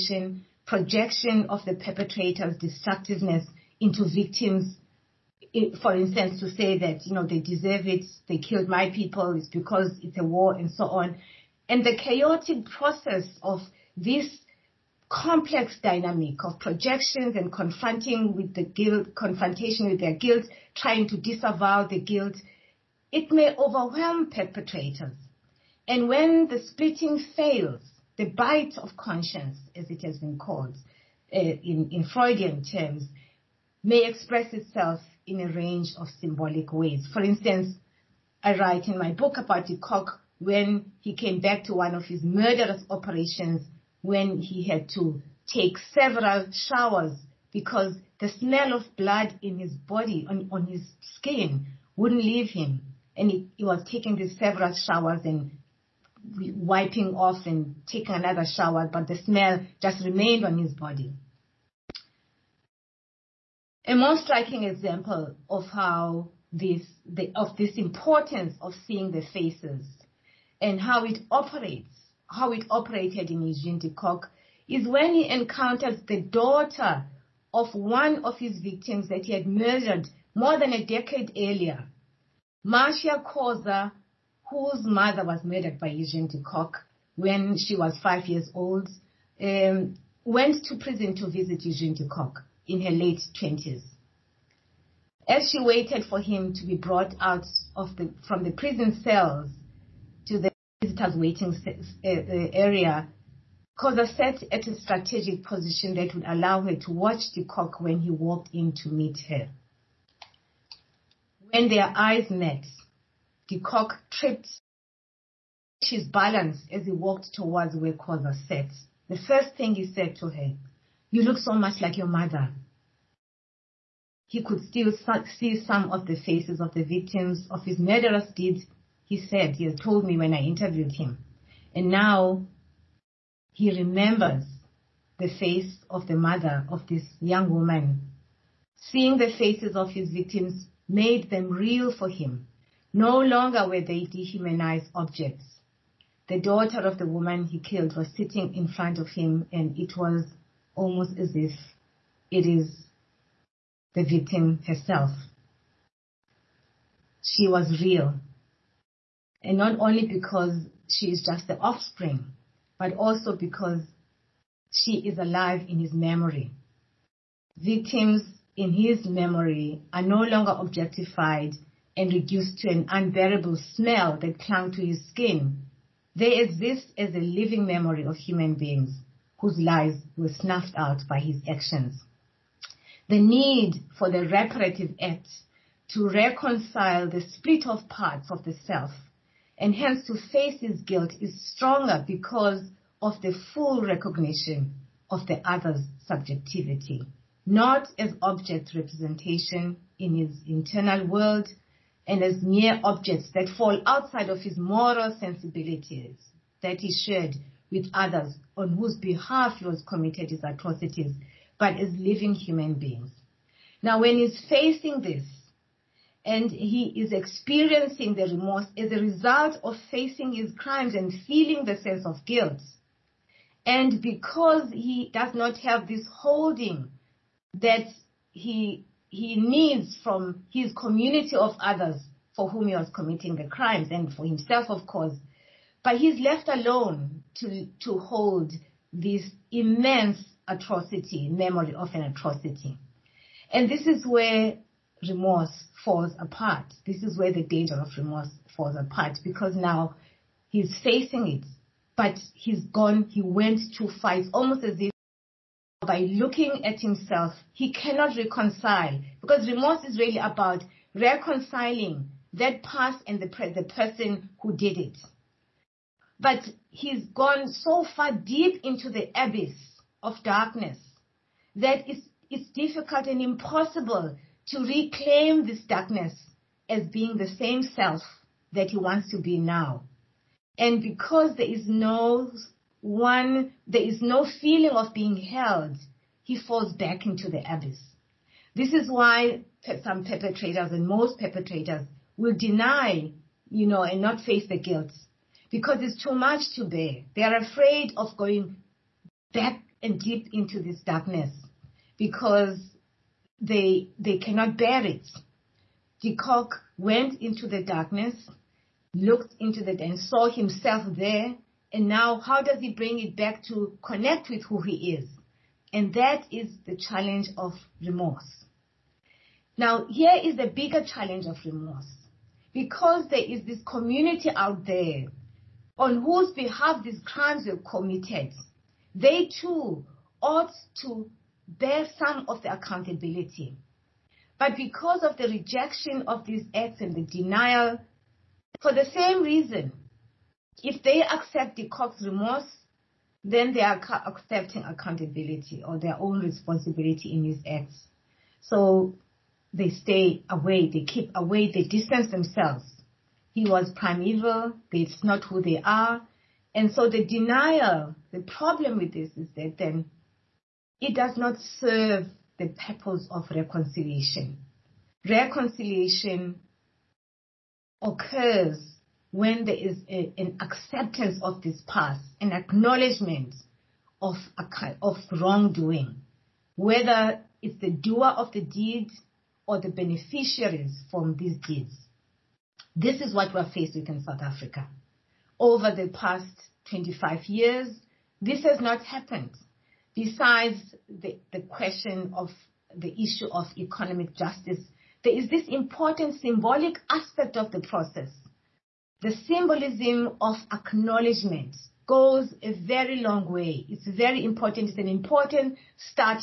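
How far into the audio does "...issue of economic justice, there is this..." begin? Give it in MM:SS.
06:33.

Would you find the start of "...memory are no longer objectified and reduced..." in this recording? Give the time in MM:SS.
02:49.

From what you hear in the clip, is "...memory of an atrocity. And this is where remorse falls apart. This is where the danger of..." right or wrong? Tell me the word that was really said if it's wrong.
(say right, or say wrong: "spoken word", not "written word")
right.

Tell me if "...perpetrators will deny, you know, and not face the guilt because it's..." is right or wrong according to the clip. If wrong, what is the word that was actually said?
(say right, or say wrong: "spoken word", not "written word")
right.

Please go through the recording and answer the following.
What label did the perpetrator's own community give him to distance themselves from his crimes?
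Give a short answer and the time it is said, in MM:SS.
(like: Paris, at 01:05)
prime evil, at 05:53.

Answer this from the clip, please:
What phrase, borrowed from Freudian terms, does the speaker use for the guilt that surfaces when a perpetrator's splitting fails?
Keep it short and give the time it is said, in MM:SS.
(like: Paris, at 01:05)
bite of conscience, at 00:28.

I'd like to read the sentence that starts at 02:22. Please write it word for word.
No longer were they dehumanized objects.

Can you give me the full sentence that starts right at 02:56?
They exist as a living memory of human beings whose lives were snuffed out by his actions.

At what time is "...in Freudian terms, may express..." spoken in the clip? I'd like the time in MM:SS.
00:31.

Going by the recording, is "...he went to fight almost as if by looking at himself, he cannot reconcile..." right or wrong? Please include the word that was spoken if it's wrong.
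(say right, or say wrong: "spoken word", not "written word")
right.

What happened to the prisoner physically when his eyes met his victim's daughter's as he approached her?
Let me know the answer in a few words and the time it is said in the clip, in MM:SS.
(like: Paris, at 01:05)
tripped his balance, at 01:54.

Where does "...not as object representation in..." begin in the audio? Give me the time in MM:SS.
03:17.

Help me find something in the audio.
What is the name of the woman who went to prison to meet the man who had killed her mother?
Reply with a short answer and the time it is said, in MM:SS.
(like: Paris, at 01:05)
Marcia Khoza, at 01:22.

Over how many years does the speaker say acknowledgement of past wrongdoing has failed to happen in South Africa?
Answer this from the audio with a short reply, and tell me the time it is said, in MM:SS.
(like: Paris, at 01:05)
25, at 06:26.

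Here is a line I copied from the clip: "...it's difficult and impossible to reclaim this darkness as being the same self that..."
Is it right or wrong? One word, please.
right.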